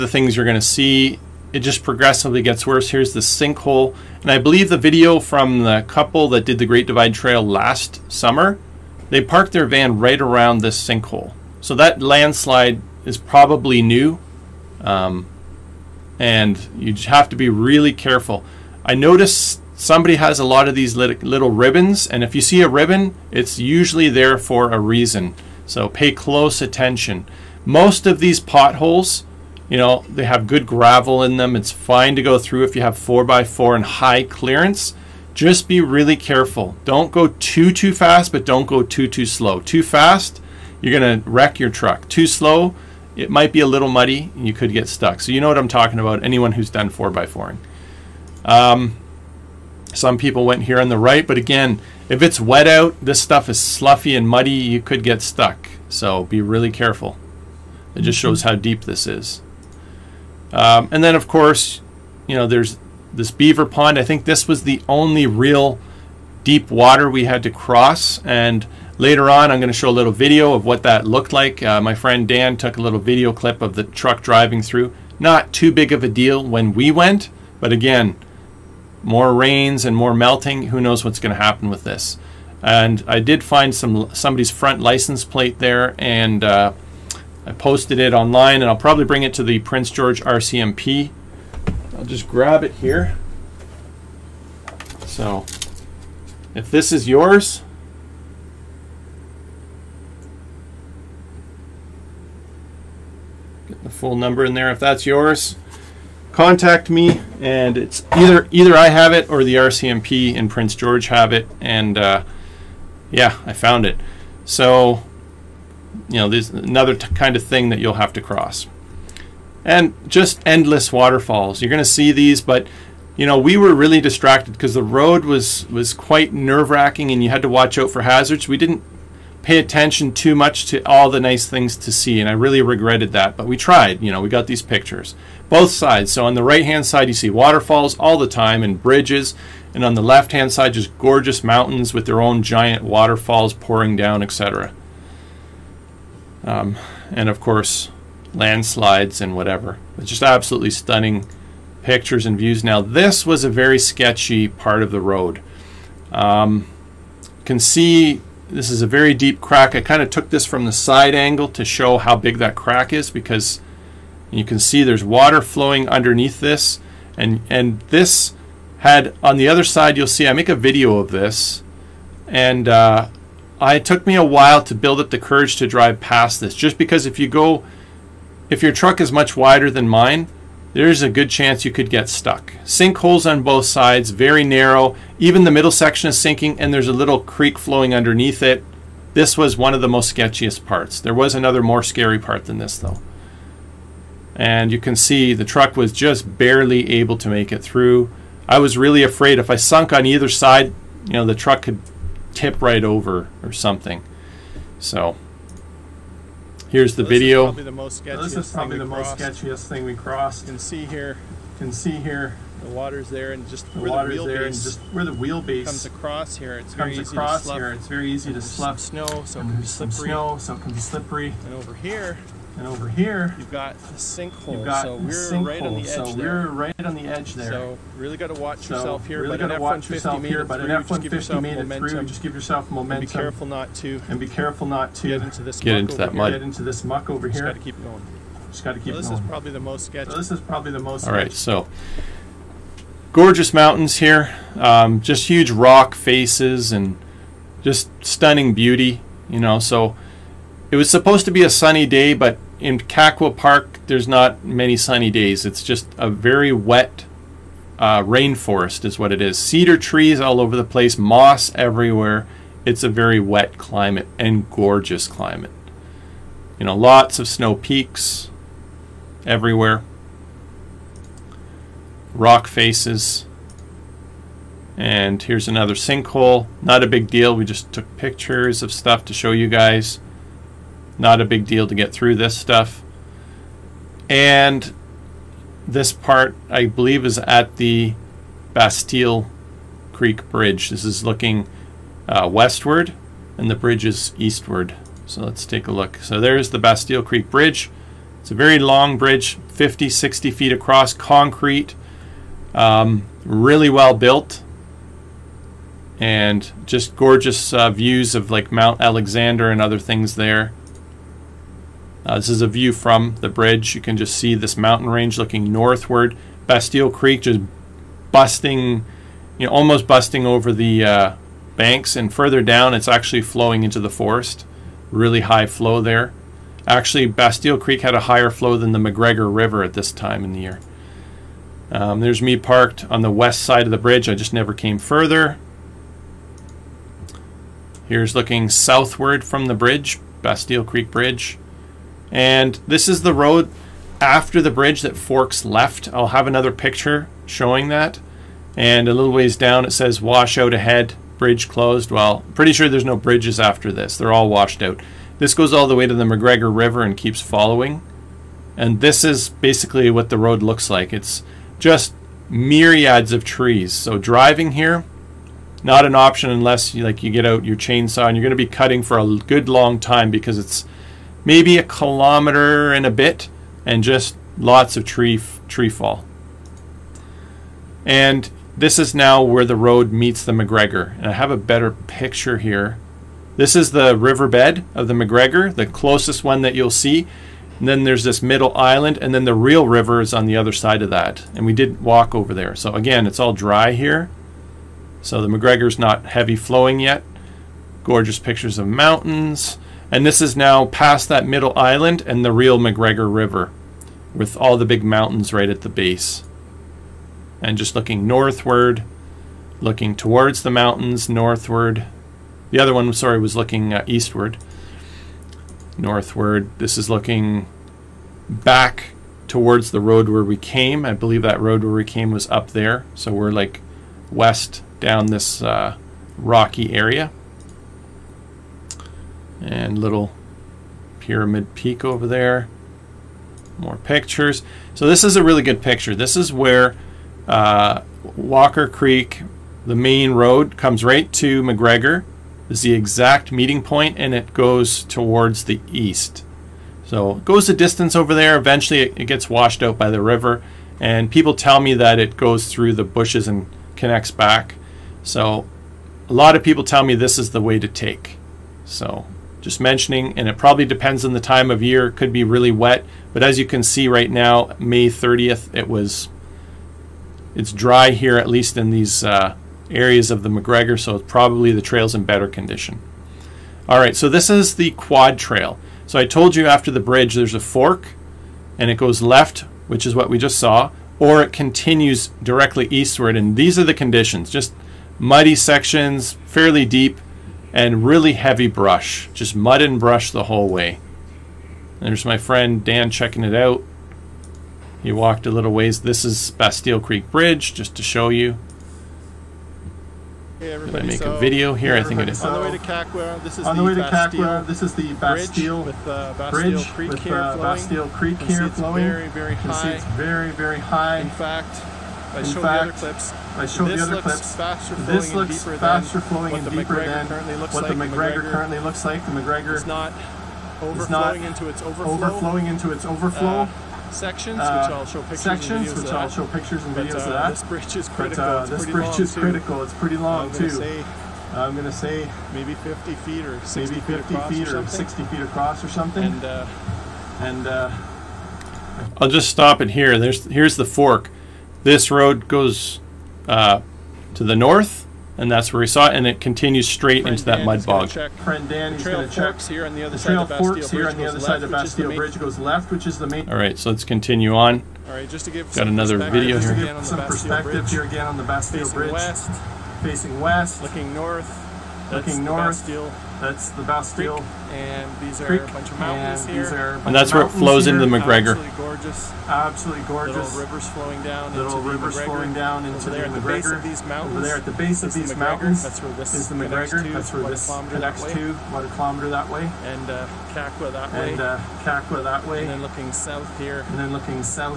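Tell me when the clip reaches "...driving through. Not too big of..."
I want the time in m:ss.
1:14.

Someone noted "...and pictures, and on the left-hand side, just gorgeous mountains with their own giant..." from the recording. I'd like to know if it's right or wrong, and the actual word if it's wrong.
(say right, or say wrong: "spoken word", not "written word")
wrong: "bridges", not "pictures".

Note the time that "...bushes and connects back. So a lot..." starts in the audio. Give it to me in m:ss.
7:32.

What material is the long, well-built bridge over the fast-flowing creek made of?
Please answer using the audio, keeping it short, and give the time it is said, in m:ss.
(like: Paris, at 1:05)
concrete, at 5:00.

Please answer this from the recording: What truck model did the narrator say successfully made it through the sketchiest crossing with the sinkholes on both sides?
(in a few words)
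F-150.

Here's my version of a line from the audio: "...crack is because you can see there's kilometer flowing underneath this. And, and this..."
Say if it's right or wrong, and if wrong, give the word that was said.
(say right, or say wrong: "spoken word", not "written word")
wrong: "water", not "kilometer".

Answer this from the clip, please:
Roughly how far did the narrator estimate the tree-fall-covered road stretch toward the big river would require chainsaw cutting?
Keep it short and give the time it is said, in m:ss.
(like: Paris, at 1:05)
a kilometer and a bit, at 6:11.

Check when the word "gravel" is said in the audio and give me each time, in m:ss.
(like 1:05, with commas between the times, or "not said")
0:30.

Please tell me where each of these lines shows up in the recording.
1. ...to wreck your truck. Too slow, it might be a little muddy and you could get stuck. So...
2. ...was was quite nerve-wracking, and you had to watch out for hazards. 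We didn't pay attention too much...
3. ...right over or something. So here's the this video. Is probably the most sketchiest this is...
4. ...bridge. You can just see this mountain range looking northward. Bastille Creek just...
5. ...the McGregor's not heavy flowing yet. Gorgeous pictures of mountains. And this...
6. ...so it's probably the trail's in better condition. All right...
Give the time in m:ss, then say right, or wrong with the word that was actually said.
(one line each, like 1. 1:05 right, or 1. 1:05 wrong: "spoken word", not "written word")
1. 0:41 right
2. 2:05 right
3. 3:22 right
4. 5:13 right
5. 6:35 right
6. 7:50 right.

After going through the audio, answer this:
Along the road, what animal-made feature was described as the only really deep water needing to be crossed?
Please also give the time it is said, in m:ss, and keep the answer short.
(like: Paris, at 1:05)
beaver pond, at 1:03.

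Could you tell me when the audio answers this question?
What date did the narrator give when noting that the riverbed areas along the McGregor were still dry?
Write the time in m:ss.
7:44.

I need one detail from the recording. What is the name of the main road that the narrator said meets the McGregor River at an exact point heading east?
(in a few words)
Walker Creek.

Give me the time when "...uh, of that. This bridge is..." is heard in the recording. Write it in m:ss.
8:46.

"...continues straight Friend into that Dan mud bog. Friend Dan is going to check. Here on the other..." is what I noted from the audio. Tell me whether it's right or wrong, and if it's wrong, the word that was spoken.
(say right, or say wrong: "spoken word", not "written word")
right.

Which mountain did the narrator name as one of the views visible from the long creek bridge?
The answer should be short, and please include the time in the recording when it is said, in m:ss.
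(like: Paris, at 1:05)
Mount Alexander, at 5:08.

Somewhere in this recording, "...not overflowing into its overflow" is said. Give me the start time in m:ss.
8:39.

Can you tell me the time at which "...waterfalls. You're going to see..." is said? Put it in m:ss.
2:00.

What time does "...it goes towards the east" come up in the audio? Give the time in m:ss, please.
7:24.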